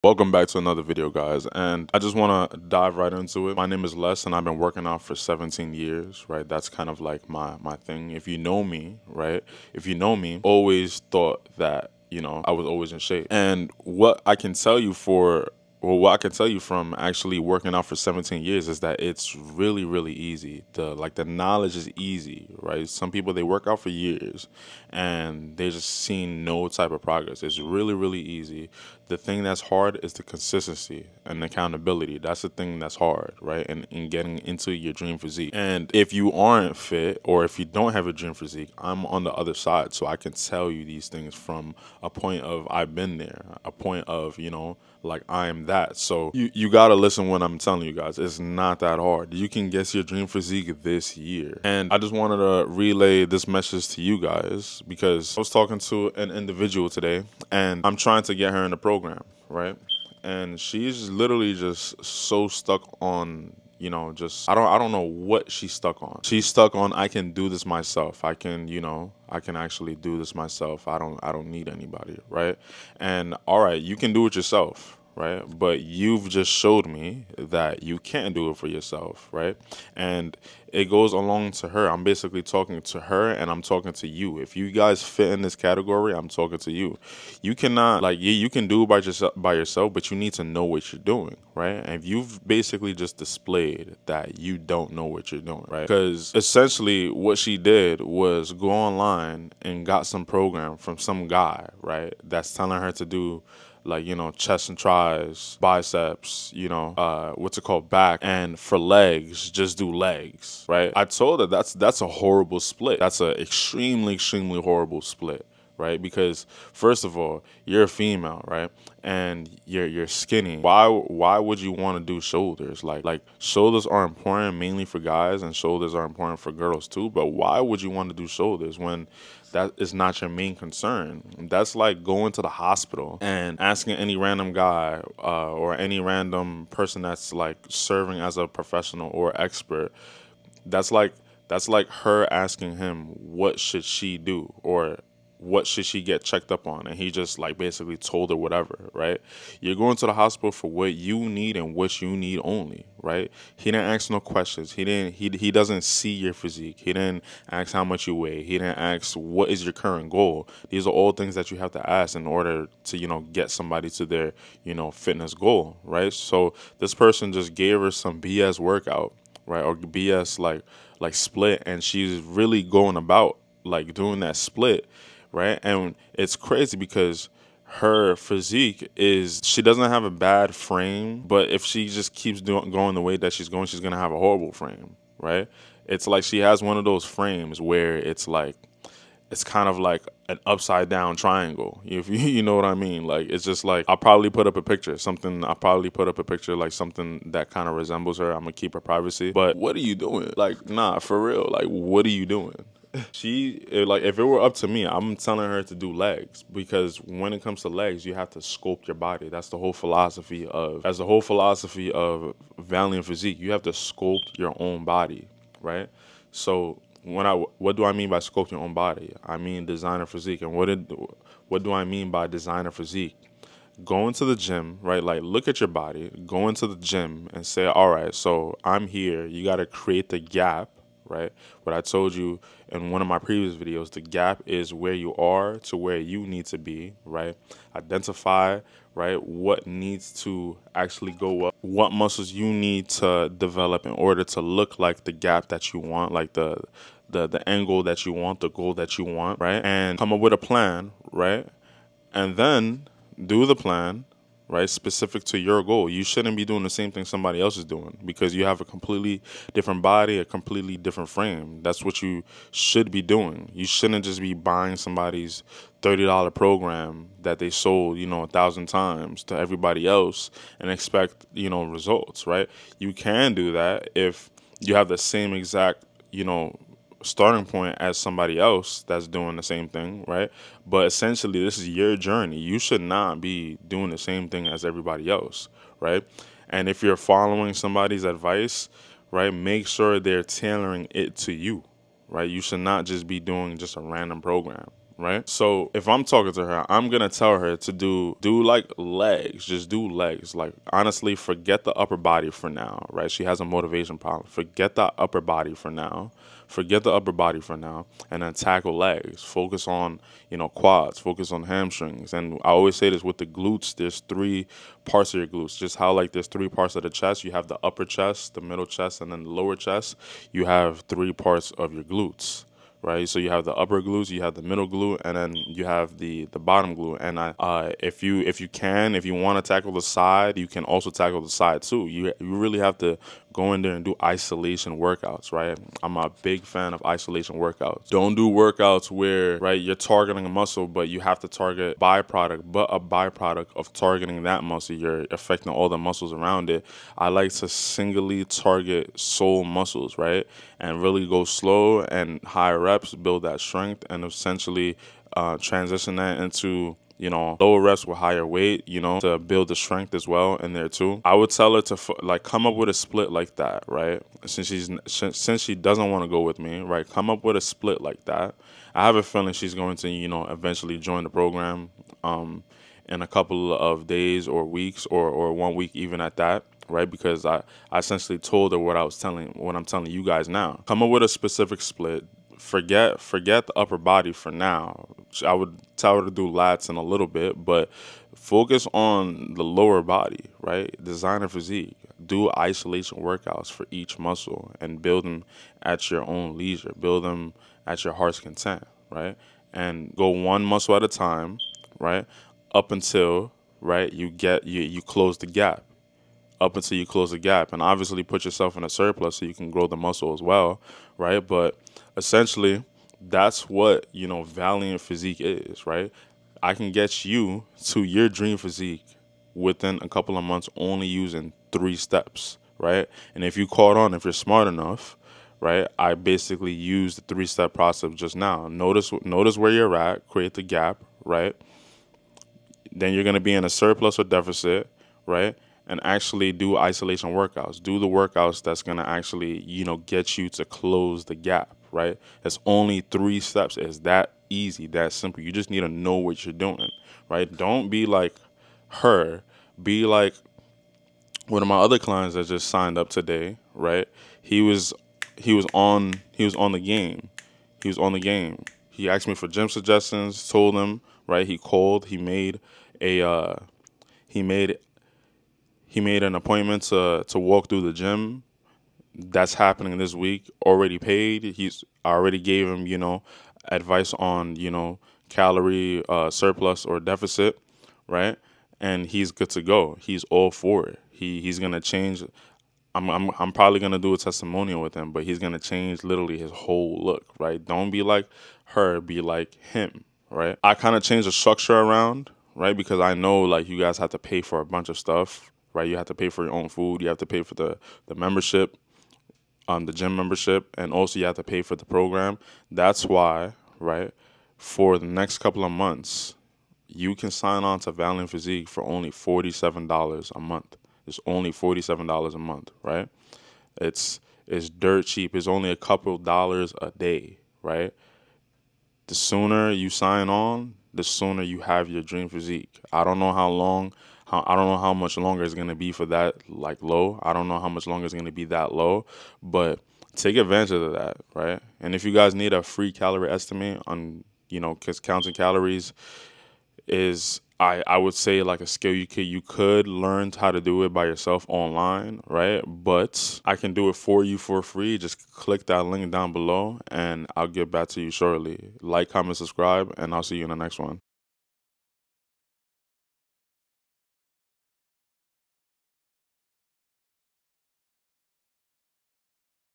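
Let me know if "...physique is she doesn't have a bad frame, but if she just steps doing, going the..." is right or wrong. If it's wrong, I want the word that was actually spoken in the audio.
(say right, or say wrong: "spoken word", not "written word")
wrong: "keeps", not "steps".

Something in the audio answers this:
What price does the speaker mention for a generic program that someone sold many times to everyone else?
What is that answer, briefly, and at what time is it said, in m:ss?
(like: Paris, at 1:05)
$30, at 4:25.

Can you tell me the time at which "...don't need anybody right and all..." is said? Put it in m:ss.
1:11.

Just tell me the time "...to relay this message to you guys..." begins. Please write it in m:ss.
0:52.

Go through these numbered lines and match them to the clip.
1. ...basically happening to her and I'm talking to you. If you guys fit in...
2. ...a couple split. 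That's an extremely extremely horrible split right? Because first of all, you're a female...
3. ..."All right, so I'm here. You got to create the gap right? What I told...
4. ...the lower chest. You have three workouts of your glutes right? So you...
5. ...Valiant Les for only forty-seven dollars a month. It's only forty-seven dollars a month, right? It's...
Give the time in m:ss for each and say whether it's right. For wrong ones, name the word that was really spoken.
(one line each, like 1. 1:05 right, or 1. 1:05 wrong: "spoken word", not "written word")
1. 1:22 wrong: "talking", not "happening"
2. 1:52 wrong: "horrible", not "couple"
3. 3:47 right
4. 5:19 wrong: "parts", not "workouts"
5. 8:27 wrong: "Physique", not "Les".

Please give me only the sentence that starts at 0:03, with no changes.
My name is Les and I've been working out for 17 years, right?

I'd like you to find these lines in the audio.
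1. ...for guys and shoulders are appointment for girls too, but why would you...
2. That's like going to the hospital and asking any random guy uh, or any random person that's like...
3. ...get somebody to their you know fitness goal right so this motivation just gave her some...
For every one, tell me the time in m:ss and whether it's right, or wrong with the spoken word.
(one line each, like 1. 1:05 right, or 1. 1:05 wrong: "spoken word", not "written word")
1. 2:04 wrong: "important", not "appointment"
2. 2:11 right
3. 2:43 wrong: "person", not "motivation".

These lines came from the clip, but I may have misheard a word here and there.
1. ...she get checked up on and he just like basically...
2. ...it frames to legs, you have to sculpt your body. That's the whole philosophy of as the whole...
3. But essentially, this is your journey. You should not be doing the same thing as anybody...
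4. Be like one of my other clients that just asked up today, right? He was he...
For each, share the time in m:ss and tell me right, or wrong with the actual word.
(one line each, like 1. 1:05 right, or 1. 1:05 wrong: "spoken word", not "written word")
1. 2:25 right
2. 3:27 wrong: "comes", not "frames"
3. 4:40 wrong: "everybody", not "anybody"
4. 7:29 wrong: "signed", not "asked".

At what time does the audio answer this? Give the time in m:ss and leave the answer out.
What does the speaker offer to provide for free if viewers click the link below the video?
8:52.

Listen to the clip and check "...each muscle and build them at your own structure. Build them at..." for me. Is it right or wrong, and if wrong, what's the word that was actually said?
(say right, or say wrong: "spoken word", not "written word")
wrong: "leisure", not "structure".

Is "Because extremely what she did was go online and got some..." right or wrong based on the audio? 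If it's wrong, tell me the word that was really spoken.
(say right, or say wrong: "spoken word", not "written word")
wrong: "essentially", not "extremely".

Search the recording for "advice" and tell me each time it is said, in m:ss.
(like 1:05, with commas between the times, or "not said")
4:48, 7:53.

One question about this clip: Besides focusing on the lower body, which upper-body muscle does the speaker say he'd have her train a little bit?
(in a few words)
lats.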